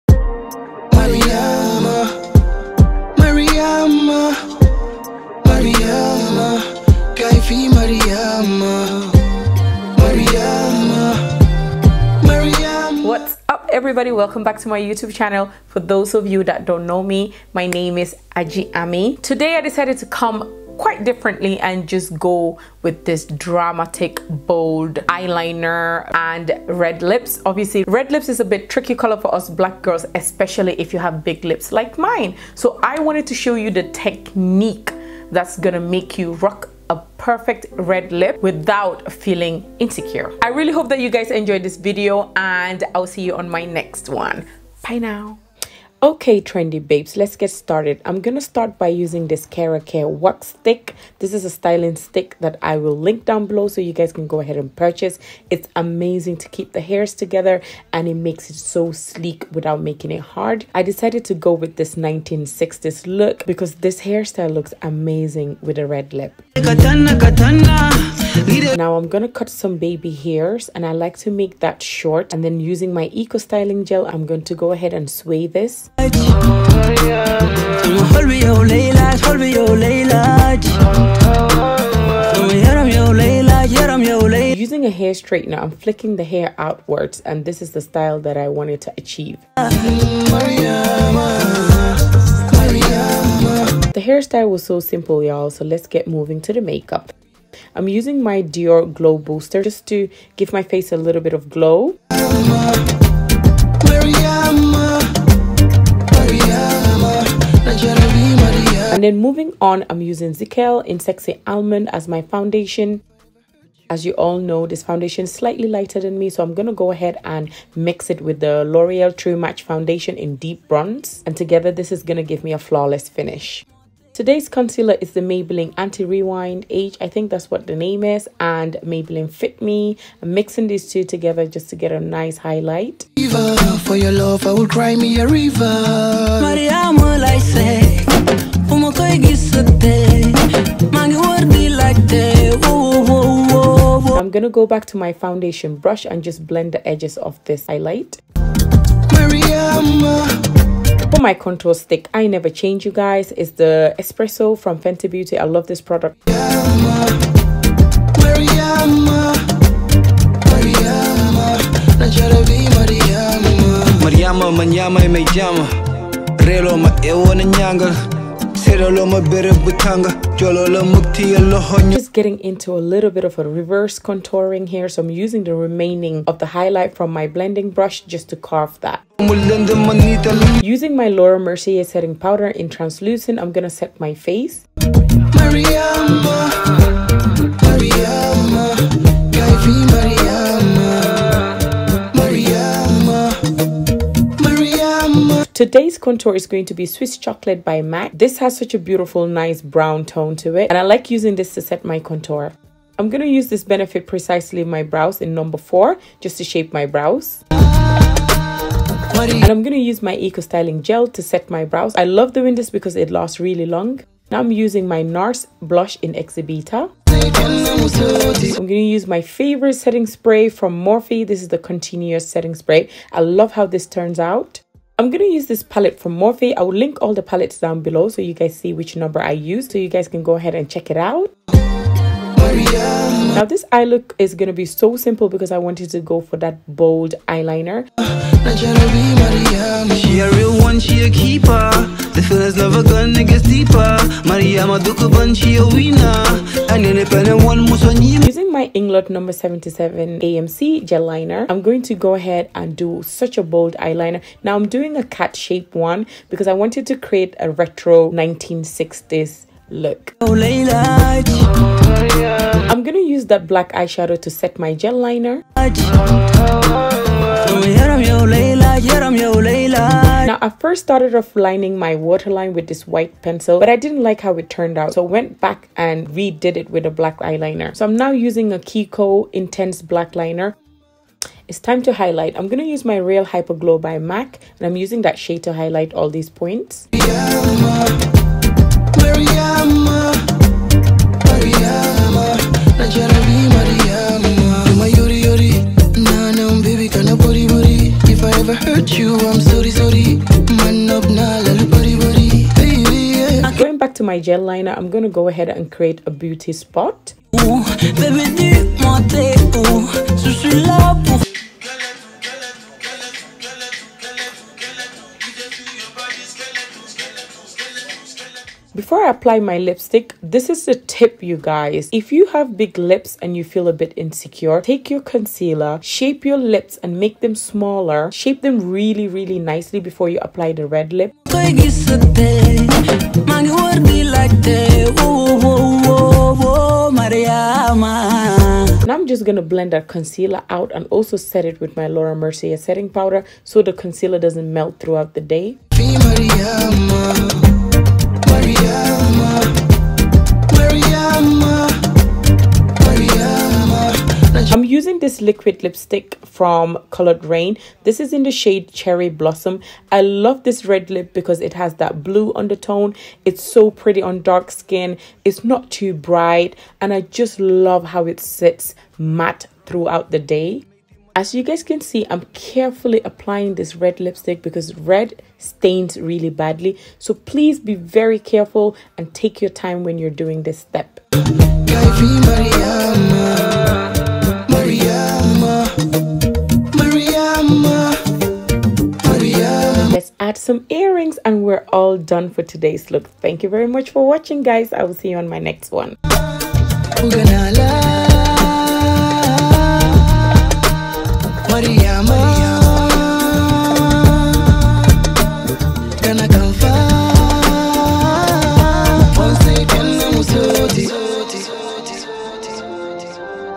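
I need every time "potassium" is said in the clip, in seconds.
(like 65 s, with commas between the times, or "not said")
not said.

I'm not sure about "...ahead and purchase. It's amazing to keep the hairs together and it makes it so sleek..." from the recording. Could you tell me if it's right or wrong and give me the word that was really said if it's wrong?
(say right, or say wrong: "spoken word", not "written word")
right.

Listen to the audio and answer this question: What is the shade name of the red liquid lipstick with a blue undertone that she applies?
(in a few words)
Cherry Blossom.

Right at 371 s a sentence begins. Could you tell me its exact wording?
As you guys can see, I'm carefully applying this red lipstick because red stains really badly.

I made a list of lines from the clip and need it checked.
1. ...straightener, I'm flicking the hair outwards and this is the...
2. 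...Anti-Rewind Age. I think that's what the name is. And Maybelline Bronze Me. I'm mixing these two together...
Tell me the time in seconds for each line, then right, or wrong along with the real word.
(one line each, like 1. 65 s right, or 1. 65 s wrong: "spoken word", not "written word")
1. 85 s right
2. 125 s wrong: "Fit", not "Bronze".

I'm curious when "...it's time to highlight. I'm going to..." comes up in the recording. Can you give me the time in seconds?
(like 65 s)
281 s.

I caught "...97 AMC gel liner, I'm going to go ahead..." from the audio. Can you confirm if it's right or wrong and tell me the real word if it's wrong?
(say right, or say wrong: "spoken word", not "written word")
wrong: "77", not "97".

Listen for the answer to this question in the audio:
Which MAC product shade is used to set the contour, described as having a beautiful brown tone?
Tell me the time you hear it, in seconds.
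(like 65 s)
196 s.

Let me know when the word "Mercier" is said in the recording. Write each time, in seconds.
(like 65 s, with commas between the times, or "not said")
181 s, 342 s.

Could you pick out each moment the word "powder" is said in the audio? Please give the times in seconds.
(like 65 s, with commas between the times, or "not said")
182 s, 342 s.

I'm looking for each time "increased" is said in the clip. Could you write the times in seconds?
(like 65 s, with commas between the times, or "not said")
not said.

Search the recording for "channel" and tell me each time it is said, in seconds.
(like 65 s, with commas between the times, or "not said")
15 s.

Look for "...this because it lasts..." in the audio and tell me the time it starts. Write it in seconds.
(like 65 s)
212 s.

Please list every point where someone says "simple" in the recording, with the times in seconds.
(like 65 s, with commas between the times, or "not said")
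94 s, 234 s.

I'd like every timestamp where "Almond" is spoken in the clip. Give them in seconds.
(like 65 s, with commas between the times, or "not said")
111 s.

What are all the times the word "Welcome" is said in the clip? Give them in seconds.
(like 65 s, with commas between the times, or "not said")
14 s.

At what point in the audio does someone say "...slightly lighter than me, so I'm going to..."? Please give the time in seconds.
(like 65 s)
115 s.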